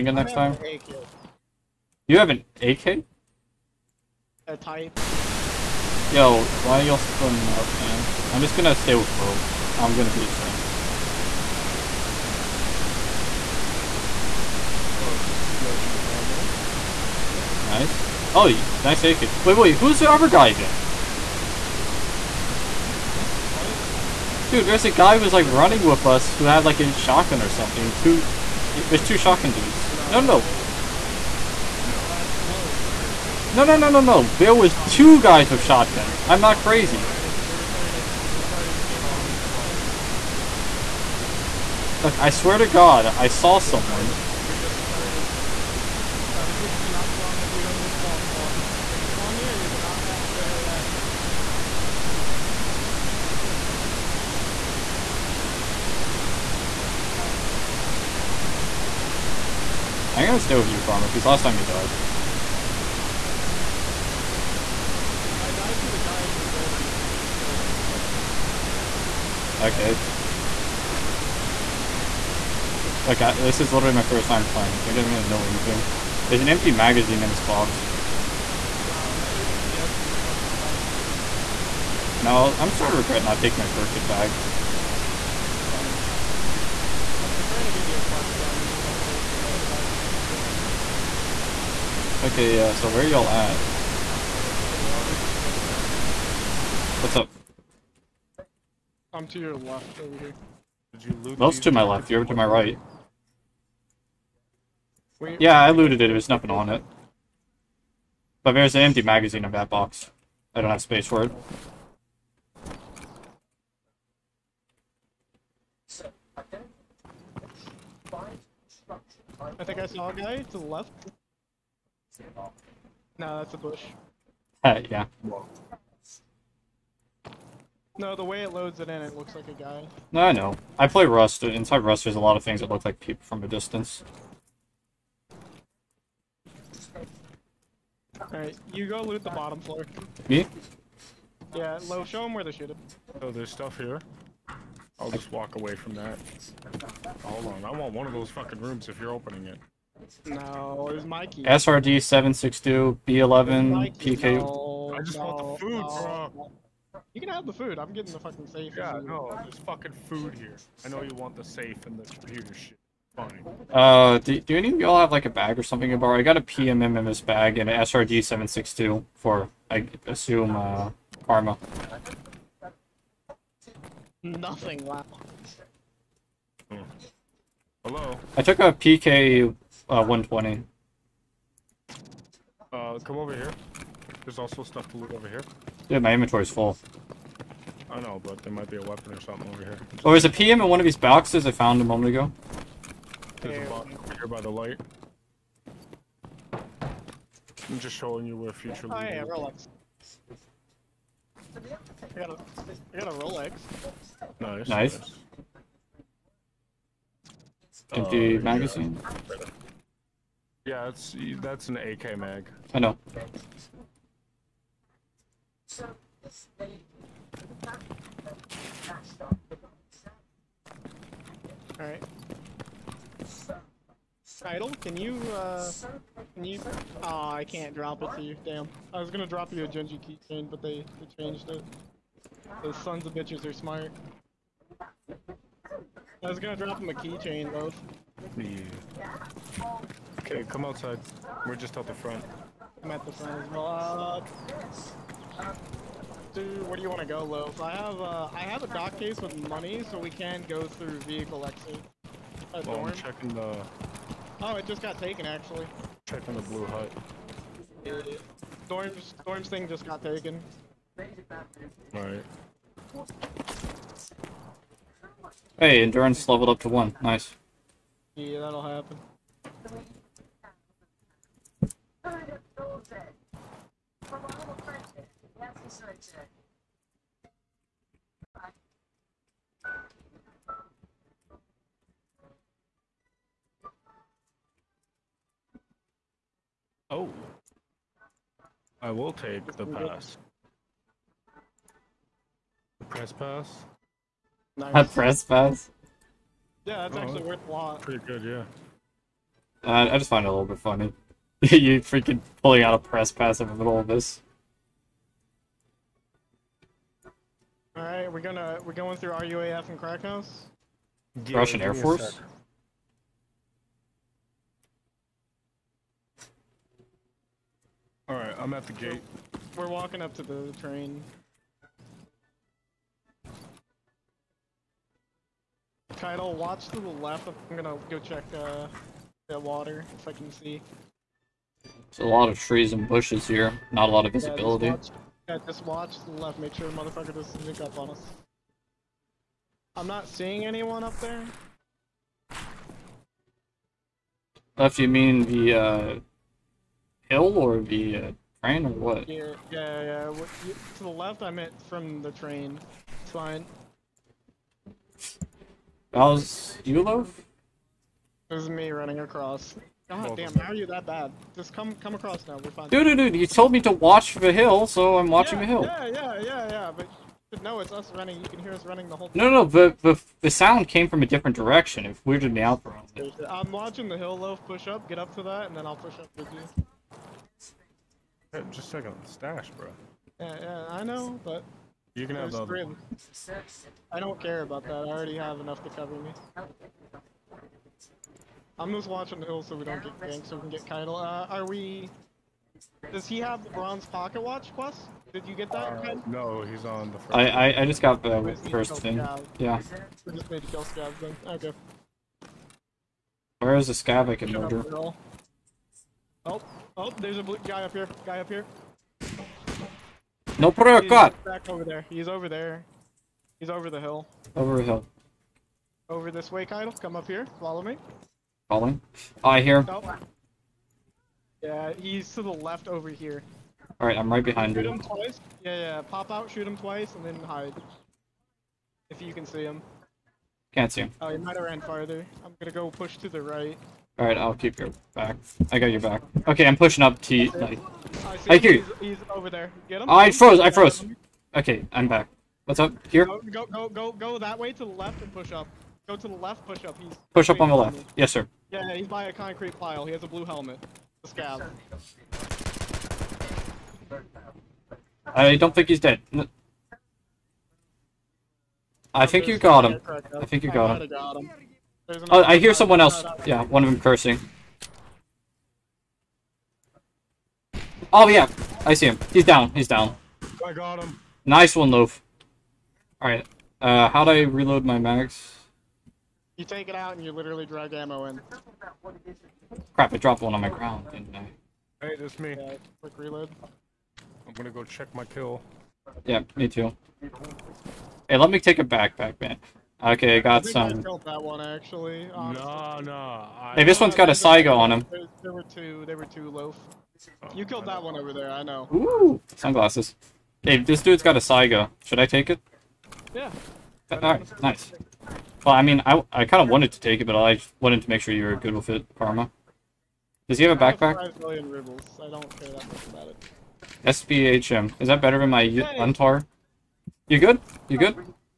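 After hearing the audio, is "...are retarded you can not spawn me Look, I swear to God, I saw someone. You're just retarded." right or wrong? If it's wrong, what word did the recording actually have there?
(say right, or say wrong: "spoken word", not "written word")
right.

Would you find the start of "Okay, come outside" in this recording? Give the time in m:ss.
4:00.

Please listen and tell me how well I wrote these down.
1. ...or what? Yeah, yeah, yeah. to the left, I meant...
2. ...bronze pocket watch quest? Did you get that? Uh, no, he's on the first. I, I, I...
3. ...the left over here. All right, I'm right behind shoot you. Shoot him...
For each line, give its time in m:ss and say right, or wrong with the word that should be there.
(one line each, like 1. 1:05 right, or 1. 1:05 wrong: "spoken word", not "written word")
1. 5:48 right
2. 6:33 right
3. 7:02 right.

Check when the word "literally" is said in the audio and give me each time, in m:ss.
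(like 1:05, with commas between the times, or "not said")
0:50, 1:13, 7:57.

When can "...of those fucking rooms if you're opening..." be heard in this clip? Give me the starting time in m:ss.
2:28.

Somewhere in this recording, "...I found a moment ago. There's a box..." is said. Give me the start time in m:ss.
3:11.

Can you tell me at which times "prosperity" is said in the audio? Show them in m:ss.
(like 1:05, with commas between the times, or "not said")
not said.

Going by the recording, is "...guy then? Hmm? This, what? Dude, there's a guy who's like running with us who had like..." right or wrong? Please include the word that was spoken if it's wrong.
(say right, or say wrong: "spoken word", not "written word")
right.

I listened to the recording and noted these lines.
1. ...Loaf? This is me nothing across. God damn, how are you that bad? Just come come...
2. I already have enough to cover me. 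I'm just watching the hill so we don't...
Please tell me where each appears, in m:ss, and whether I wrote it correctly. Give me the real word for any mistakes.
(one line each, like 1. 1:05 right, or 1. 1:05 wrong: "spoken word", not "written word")
1. 5:56 wrong: "running", not "nothing"
2. 6:24 right.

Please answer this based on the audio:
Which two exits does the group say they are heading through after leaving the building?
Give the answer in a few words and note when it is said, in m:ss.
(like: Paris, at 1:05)
RUAF and Krakow, at 5:09.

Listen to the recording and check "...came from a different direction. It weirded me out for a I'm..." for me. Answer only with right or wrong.
right.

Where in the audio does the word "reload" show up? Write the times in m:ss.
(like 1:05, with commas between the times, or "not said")
7:54, 8:02.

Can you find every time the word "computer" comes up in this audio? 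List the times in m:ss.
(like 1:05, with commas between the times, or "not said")
2:42.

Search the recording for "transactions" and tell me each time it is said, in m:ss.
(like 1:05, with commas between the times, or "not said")
not said.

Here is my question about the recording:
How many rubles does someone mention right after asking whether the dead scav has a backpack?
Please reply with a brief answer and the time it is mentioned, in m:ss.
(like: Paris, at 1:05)
5 million, at 8:30.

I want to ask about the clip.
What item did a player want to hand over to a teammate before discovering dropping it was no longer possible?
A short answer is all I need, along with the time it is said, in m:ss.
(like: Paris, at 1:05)
Genji keychain, at 3:49.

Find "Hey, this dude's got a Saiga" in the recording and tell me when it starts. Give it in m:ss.
8:20.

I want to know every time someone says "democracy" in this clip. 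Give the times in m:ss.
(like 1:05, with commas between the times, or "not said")
not said.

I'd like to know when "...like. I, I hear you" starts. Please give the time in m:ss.
7:17.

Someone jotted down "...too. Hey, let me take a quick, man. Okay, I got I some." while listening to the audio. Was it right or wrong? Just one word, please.
wrong.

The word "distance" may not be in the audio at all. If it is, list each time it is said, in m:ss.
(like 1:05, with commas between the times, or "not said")
2:13.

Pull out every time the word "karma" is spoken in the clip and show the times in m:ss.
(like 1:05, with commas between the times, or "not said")
1:00, 2:51, 8:28.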